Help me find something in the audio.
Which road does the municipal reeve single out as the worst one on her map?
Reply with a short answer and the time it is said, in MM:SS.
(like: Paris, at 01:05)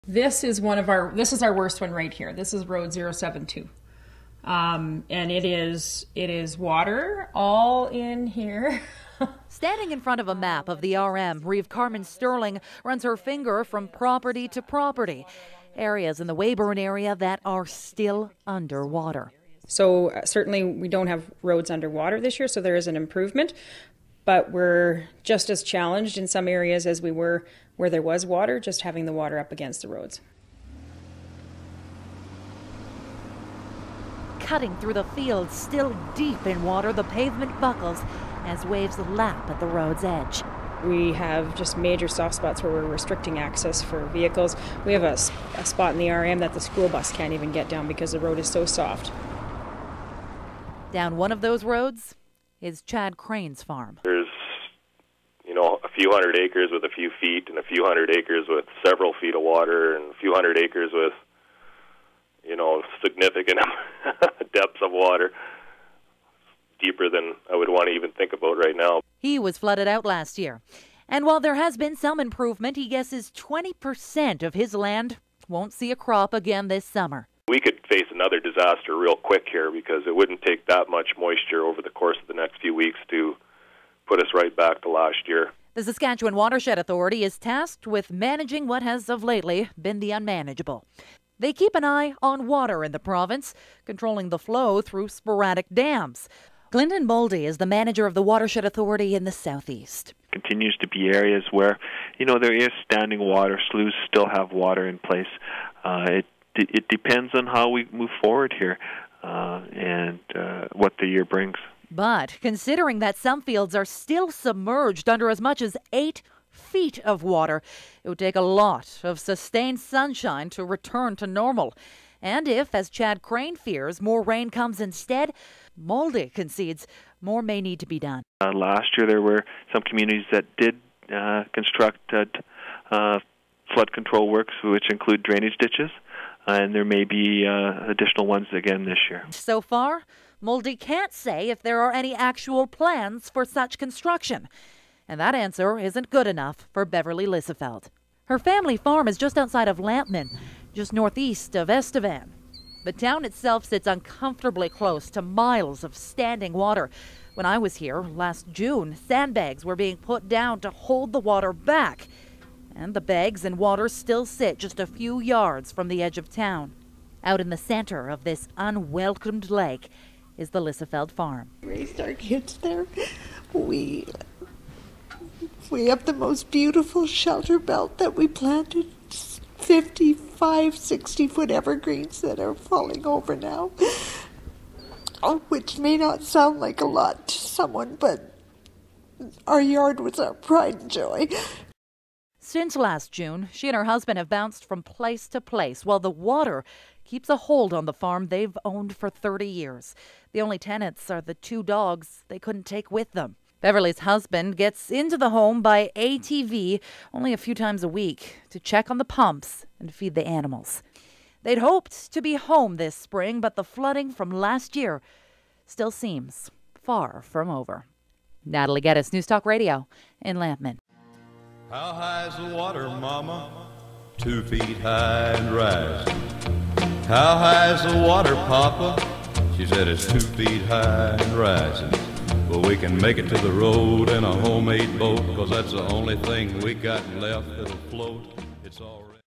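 Road 072, at 00:02.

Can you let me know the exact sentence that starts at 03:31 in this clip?
They'd hoped to be home this spring, but the flooding from last year still seems far from over.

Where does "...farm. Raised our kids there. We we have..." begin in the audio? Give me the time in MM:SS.
02:51.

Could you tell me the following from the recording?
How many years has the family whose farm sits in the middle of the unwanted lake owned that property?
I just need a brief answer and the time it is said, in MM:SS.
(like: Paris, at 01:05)
30, at 03:19.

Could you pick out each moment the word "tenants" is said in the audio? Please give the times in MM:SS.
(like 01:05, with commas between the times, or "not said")
03:20.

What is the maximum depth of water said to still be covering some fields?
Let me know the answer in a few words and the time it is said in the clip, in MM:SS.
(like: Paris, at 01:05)
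8 feet, at 01:55.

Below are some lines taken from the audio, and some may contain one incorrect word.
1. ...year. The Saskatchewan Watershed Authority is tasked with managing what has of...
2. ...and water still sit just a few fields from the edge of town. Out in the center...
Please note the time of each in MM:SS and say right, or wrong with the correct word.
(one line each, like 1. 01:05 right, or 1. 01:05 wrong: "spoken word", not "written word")
1. 01:25 right
2. 02:43 wrong: "yards", not "fields".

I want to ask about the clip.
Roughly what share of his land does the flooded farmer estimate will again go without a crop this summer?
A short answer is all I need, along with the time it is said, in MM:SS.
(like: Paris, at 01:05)
20%, at 01:13.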